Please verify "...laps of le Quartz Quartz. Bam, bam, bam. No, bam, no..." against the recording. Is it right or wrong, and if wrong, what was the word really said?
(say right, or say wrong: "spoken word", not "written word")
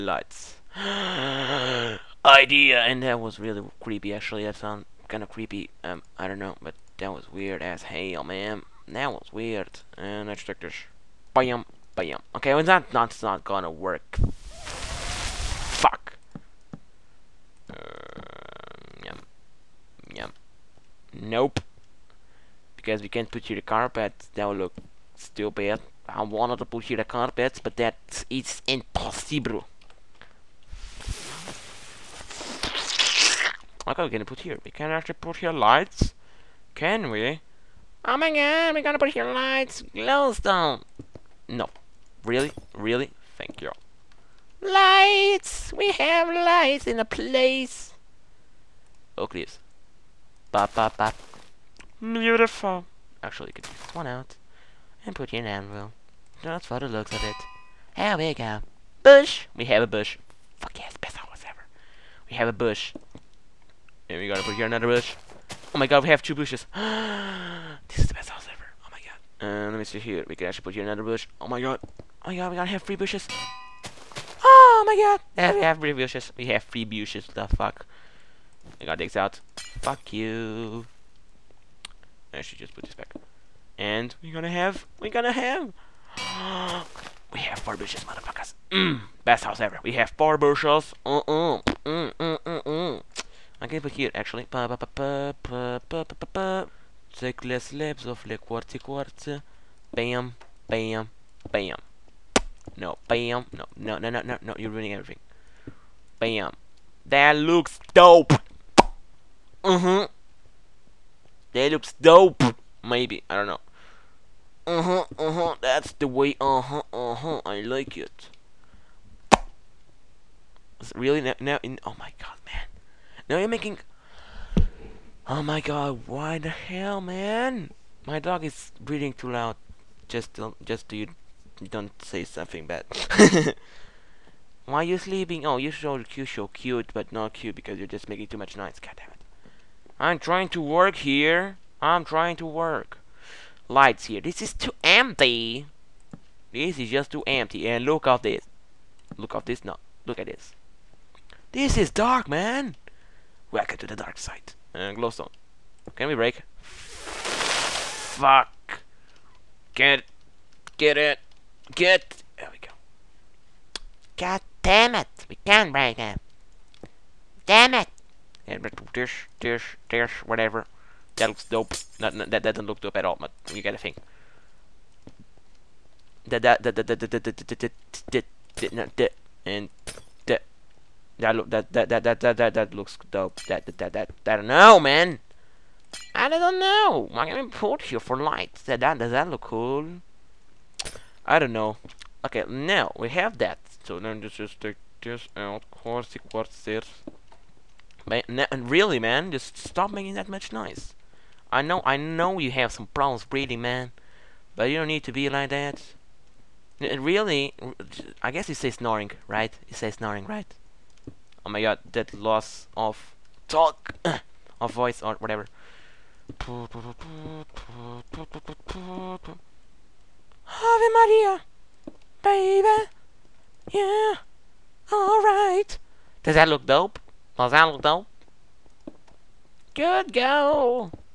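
right.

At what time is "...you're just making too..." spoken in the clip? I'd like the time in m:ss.
2:17.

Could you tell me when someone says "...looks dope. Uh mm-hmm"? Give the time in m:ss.
1:47.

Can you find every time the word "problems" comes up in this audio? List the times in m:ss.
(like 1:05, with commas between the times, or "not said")
3:22.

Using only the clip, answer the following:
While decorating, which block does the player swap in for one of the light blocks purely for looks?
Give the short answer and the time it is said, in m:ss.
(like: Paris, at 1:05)
anvil, at 0:55.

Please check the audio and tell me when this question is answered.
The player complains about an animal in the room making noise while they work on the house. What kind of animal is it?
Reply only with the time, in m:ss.
2:08.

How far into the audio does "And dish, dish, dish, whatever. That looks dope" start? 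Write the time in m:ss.
2:48.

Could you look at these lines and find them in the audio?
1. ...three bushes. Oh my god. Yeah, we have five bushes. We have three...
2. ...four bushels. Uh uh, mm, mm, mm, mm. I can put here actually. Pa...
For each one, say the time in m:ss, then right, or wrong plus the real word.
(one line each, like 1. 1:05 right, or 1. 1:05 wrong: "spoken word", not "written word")
1. 1:12 wrong: "three", not "five"
2. 1:30 right.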